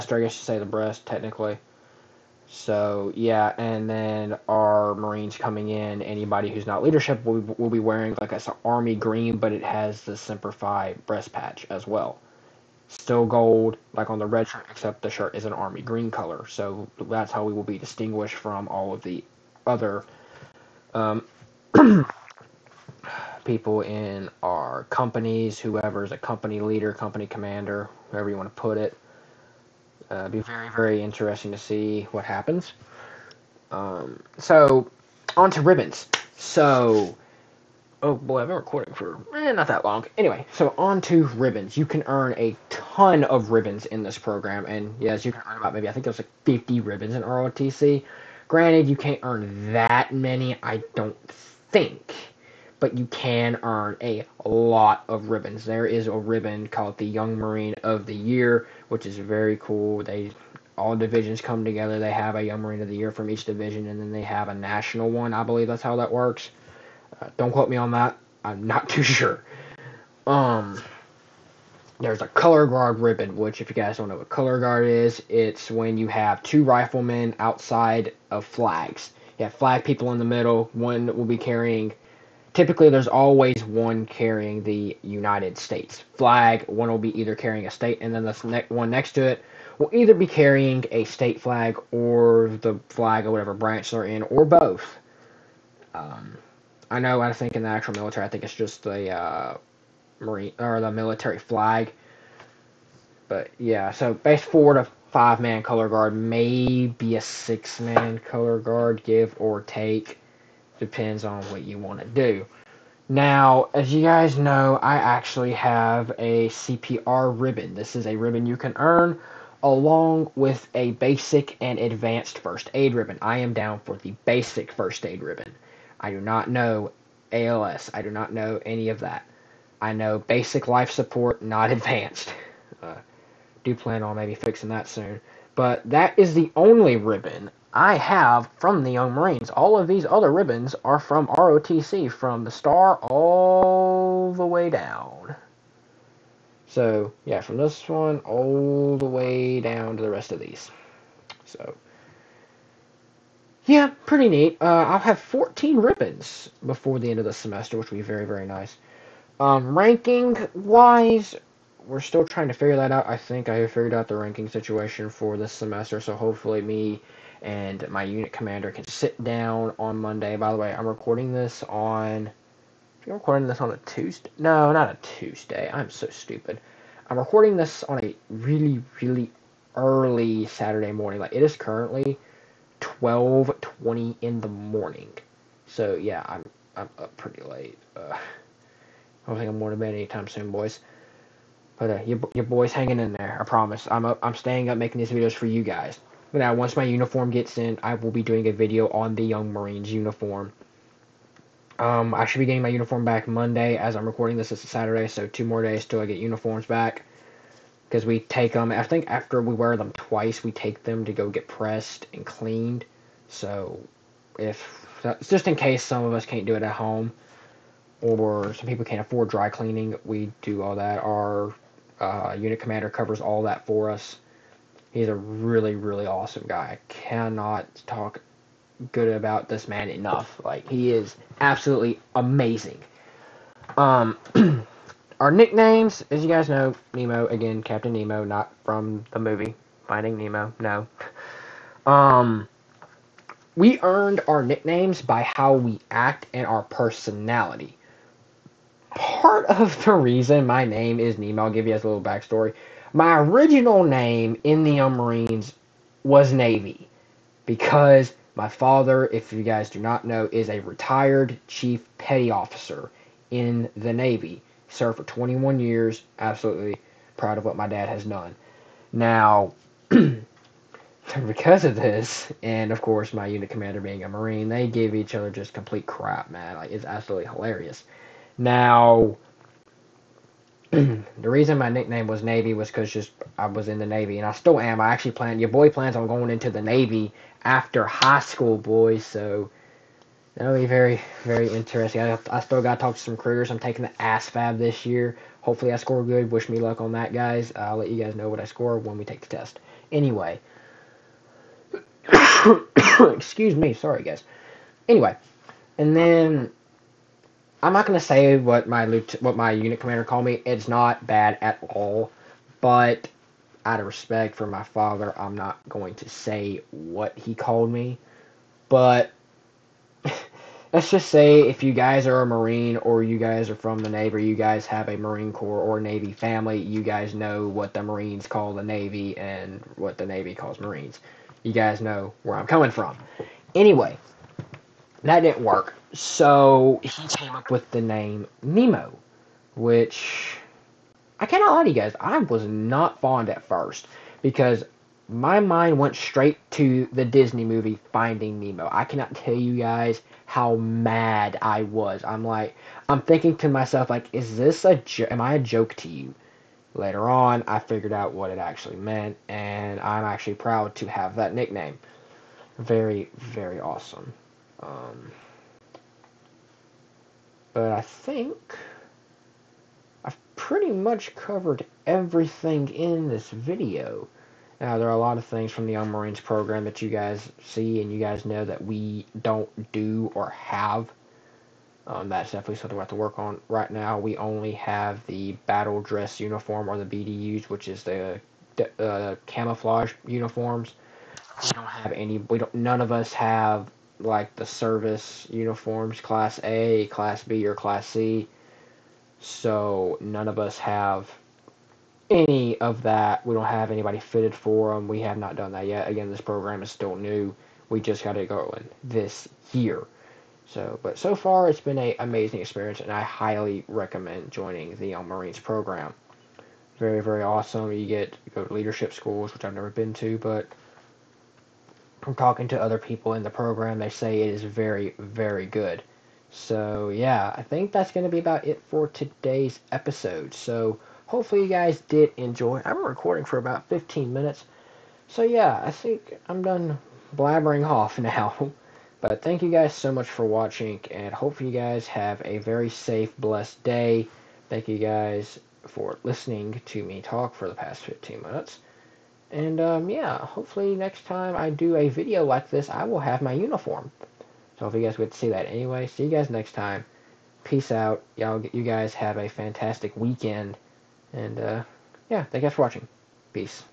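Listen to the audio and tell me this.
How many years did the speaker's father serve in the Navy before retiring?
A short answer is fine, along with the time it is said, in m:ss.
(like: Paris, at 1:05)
21, at 4:25.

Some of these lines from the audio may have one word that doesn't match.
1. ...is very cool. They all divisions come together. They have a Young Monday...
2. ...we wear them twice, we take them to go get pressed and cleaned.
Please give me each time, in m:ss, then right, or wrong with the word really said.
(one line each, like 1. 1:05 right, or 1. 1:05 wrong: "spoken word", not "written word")
1. 0:59 wrong: "Marine", not "Monday"
2. 3:29 right.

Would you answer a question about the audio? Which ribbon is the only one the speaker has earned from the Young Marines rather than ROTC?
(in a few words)
CPR ribbon.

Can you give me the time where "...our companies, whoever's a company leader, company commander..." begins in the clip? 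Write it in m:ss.
0:24.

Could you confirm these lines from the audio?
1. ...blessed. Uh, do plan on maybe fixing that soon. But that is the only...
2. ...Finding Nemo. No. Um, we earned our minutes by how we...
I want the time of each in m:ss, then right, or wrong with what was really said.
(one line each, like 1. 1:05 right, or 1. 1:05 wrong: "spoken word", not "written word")
1. 2:11 wrong: "advanced", not "blessed"
2. 3:59 wrong: "nicknames", not "minutes".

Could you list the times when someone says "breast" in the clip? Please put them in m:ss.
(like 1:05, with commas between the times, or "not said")
0:00, 0:11.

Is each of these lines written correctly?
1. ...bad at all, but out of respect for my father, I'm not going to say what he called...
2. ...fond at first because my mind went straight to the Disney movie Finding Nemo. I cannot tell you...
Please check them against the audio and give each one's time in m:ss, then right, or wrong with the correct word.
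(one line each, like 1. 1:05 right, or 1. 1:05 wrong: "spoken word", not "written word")
1. 5:11 right
2. 5:43 right.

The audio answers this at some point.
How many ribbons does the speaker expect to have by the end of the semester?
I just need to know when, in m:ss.
2:35.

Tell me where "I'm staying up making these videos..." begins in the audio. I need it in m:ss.
3:14.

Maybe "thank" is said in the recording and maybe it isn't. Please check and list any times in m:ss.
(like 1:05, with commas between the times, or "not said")
7:19, 7:24, 7:42.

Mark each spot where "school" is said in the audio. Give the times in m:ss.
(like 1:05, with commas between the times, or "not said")
4:48, 6:58.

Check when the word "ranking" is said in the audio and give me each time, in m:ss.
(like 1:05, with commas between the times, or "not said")
2:39, 2:44.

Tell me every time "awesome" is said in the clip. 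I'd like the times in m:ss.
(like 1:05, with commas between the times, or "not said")
3:46, 6:03, 6:57.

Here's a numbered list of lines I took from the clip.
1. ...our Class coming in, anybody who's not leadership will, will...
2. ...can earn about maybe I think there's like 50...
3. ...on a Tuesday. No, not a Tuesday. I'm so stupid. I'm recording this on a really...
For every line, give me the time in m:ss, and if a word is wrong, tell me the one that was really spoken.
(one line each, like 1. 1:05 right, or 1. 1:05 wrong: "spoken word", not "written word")
1. 0:04 wrong: "Marines", not "Class"
2. 0:45 right
3. 2:53 right.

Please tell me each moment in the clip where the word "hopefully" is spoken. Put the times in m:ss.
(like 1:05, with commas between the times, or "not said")
2:46, 4:55, 7:11, 7:21, 7:30.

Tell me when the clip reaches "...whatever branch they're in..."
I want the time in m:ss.
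1:33.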